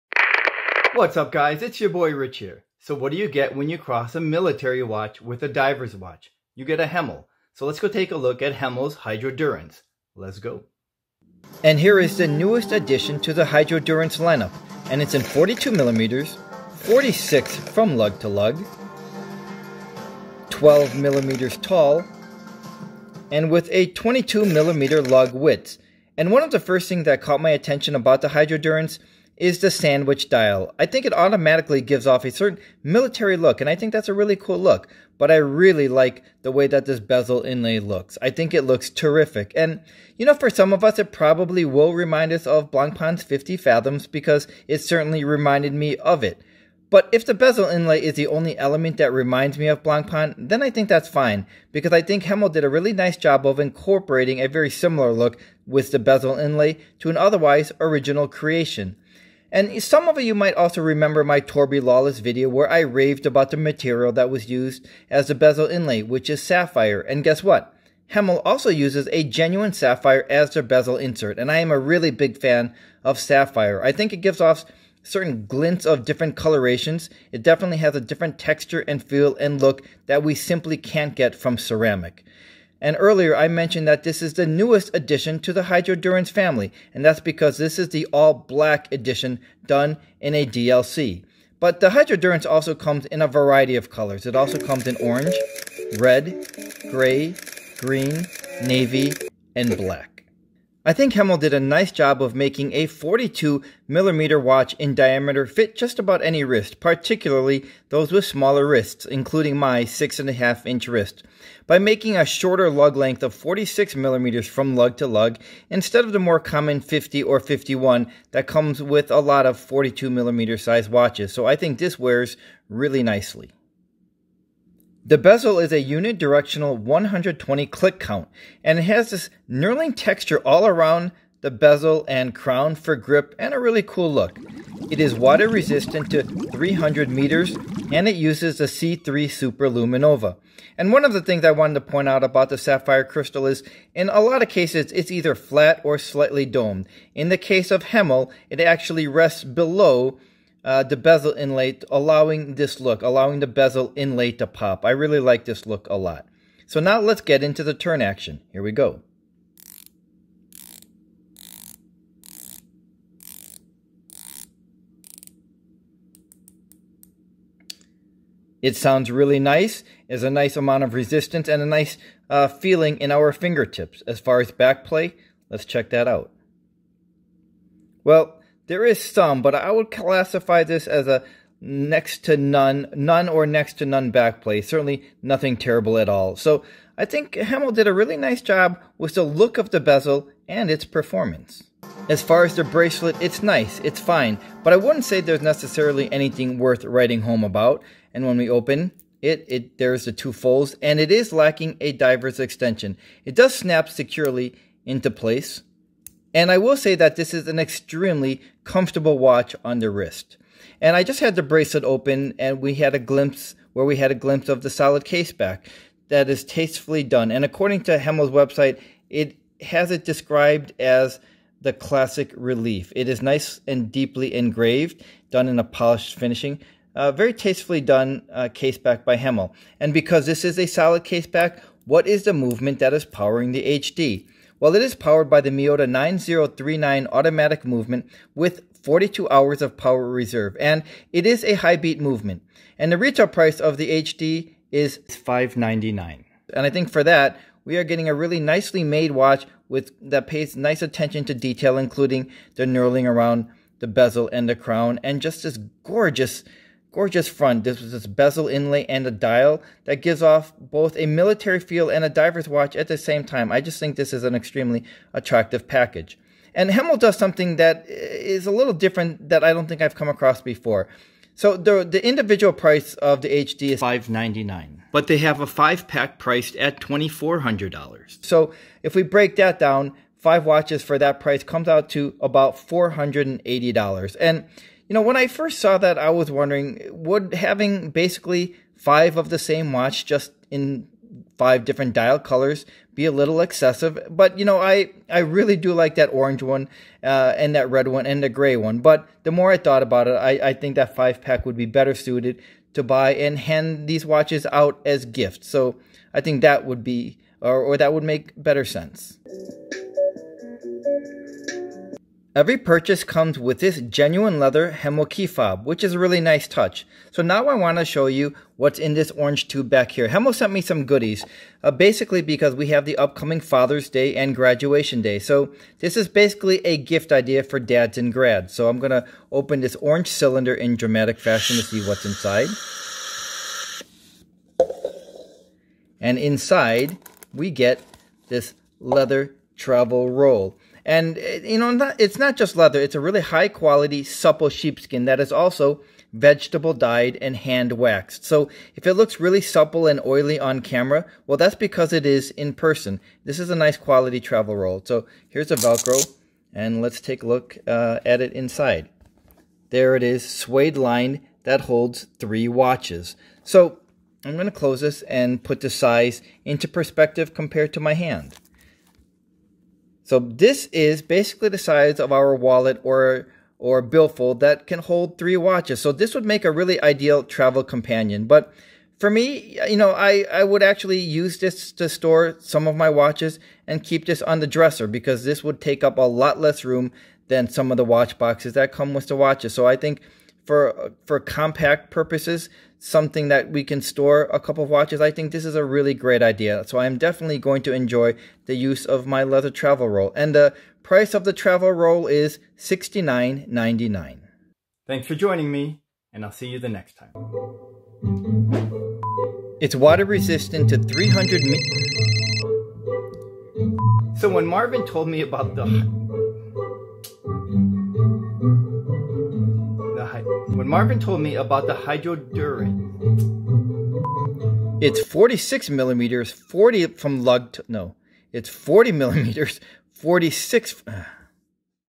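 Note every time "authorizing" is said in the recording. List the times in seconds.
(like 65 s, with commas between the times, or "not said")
not said.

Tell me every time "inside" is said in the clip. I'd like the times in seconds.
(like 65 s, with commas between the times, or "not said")
332 s, 336 s, 358 s.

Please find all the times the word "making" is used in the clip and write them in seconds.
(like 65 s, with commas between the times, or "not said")
102 s, 111 s.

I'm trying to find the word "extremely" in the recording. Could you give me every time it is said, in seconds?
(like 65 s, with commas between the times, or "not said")
207 s, 264 s.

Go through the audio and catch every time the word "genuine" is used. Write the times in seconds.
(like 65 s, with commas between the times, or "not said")
69 s, 313 s.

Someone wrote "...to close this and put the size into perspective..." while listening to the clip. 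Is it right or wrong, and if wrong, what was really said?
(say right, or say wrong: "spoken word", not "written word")
right.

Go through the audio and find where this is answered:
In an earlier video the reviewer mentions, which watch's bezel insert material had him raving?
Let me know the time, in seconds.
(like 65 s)
61 s.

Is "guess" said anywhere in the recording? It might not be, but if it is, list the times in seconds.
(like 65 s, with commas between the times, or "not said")
67 s.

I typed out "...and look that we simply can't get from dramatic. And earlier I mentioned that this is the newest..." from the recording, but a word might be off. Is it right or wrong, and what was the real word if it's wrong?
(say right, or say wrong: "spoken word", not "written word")
wrong: "ceramic", not "dramatic".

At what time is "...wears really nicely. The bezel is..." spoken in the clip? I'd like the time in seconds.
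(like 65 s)
121 s.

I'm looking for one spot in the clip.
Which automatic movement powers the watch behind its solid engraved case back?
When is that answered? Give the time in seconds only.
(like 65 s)
235 s.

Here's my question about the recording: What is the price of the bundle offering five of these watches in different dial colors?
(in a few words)
$2,400.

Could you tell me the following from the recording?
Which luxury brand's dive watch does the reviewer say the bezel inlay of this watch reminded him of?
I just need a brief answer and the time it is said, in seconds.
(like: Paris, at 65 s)
Blancpain's 50 Fathoms, at 42 s.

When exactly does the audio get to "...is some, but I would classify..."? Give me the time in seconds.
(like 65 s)
178 s.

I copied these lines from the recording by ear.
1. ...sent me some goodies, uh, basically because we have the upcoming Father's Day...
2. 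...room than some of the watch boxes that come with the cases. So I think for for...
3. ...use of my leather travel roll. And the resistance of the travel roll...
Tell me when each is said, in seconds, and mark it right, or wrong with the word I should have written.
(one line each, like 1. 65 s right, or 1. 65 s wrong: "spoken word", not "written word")
1. 320 s right
2. 386 s wrong: "watches", not "cases"
3. 398 s wrong: "price", not "resistance".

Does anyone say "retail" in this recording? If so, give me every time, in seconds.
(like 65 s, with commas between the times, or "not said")
242 s.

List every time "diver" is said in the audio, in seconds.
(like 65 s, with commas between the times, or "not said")
5 s, 201 s, 262 s.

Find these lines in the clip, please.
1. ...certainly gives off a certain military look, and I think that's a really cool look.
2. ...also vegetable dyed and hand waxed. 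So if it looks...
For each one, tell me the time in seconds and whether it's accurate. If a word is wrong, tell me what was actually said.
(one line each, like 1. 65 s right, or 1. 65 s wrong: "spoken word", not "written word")
1. 31 s wrong: "automatically", not "certainly"
2. 345 s right.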